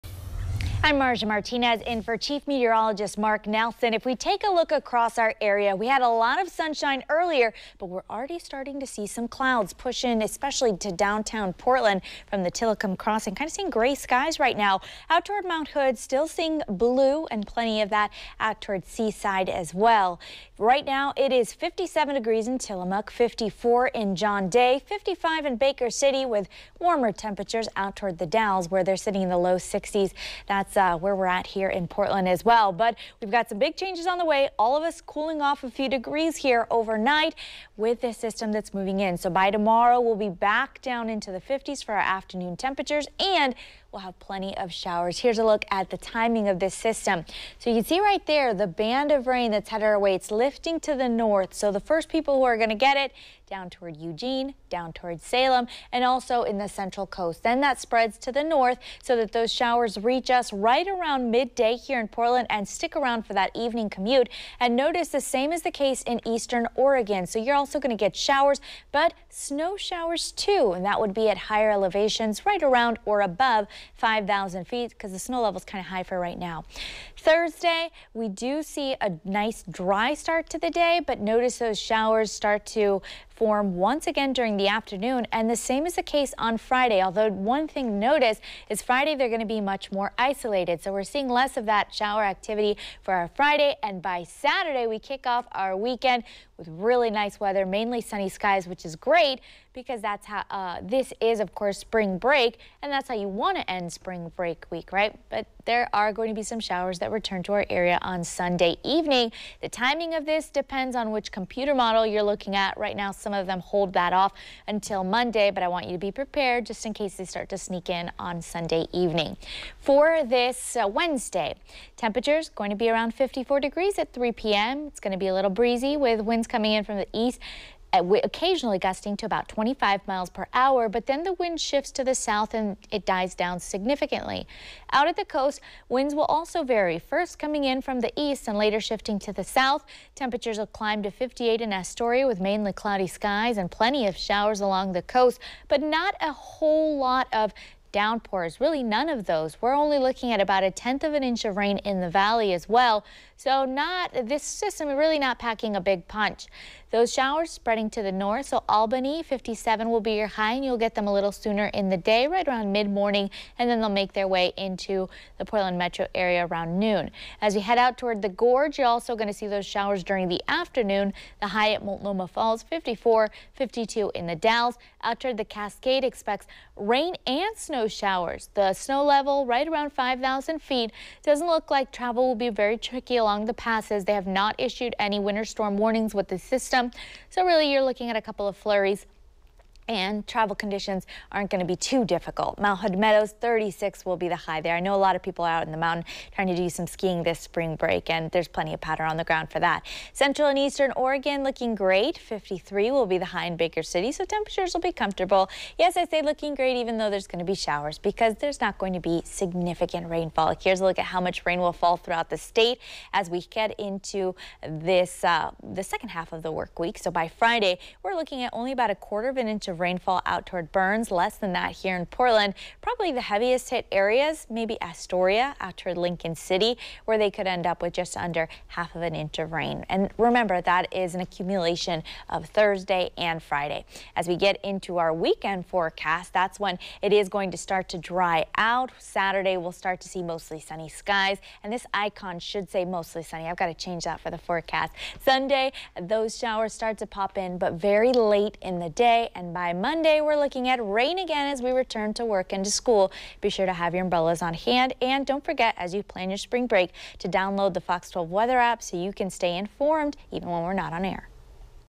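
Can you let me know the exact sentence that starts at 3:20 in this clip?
Central and eastern Oregon looking great.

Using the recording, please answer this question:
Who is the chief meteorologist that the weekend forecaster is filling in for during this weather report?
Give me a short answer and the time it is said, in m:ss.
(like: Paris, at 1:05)
Mark Nelson, at 0:03.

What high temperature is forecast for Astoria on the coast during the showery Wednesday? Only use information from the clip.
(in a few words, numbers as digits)
58.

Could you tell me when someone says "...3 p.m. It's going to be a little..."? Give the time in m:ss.
2:04.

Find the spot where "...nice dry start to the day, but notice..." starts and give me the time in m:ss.
1:19.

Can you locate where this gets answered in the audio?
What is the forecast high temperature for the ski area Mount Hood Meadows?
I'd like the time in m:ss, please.
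3:13.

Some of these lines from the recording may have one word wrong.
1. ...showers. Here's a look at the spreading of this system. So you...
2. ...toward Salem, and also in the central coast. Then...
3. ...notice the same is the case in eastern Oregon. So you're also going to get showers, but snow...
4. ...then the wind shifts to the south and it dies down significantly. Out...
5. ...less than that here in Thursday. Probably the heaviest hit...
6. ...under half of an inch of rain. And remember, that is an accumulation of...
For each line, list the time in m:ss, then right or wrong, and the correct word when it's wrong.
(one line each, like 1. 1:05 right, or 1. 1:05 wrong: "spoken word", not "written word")
1. 0:44 wrong: "timing", not "spreading"
2. 0:54 right
3. 1:04 right
4. 2:11 right
5. 3:41 wrong: "Portland", not "Thursday"
6. 3:48 right.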